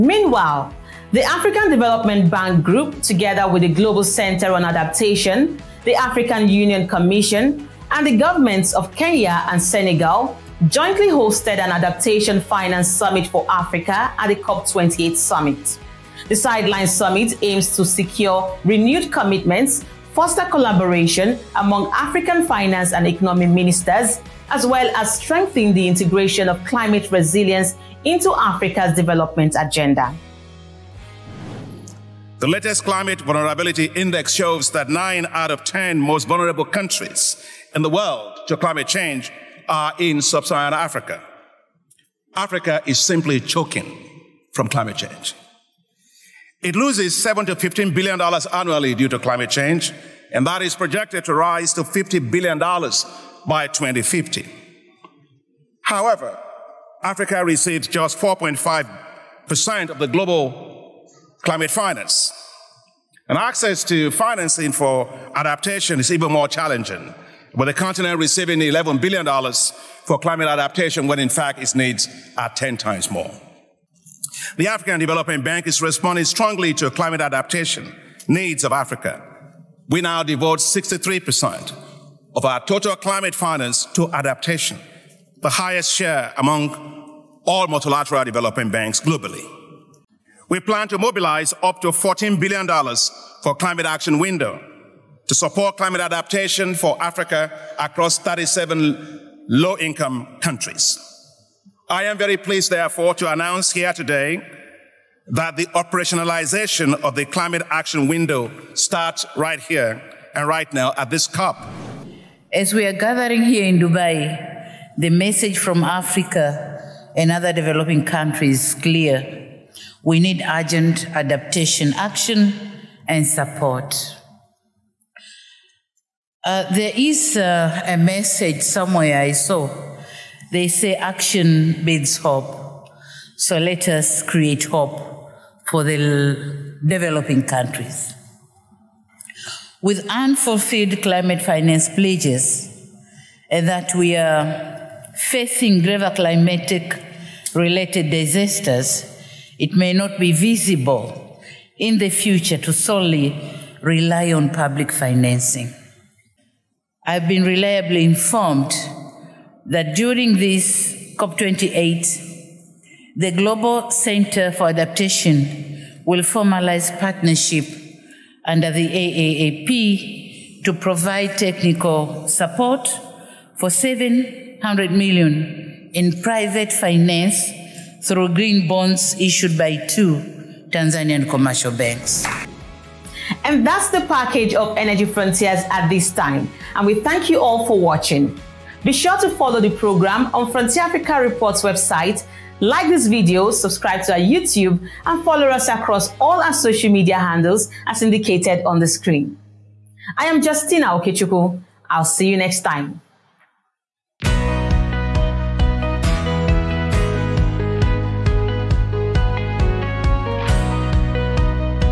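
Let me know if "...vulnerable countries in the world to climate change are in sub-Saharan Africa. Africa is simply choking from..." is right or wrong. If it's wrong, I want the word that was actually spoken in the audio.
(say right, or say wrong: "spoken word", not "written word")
right.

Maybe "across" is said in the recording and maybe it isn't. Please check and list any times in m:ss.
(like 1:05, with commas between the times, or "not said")
1:37, 3:15.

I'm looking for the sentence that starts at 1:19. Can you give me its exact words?
We now devote 63% of our total climate finance to adaptation, the highest share among all multilateral development banks globally.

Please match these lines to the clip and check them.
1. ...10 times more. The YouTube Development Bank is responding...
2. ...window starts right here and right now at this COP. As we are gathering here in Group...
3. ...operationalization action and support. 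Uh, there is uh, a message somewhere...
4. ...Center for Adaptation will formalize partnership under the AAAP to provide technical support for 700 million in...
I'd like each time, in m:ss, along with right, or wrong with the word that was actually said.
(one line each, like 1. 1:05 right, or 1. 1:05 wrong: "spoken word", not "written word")
1. 1:12 wrong: "African", not "YouTube"
2. 1:48 wrong: "Dubai", not "Group"
3. 2:01 wrong: "adaptation", not "operationalization"
4. 2:43 right.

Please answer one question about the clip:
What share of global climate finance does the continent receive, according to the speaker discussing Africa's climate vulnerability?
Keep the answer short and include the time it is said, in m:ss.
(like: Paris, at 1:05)
4.5%, at 0:58.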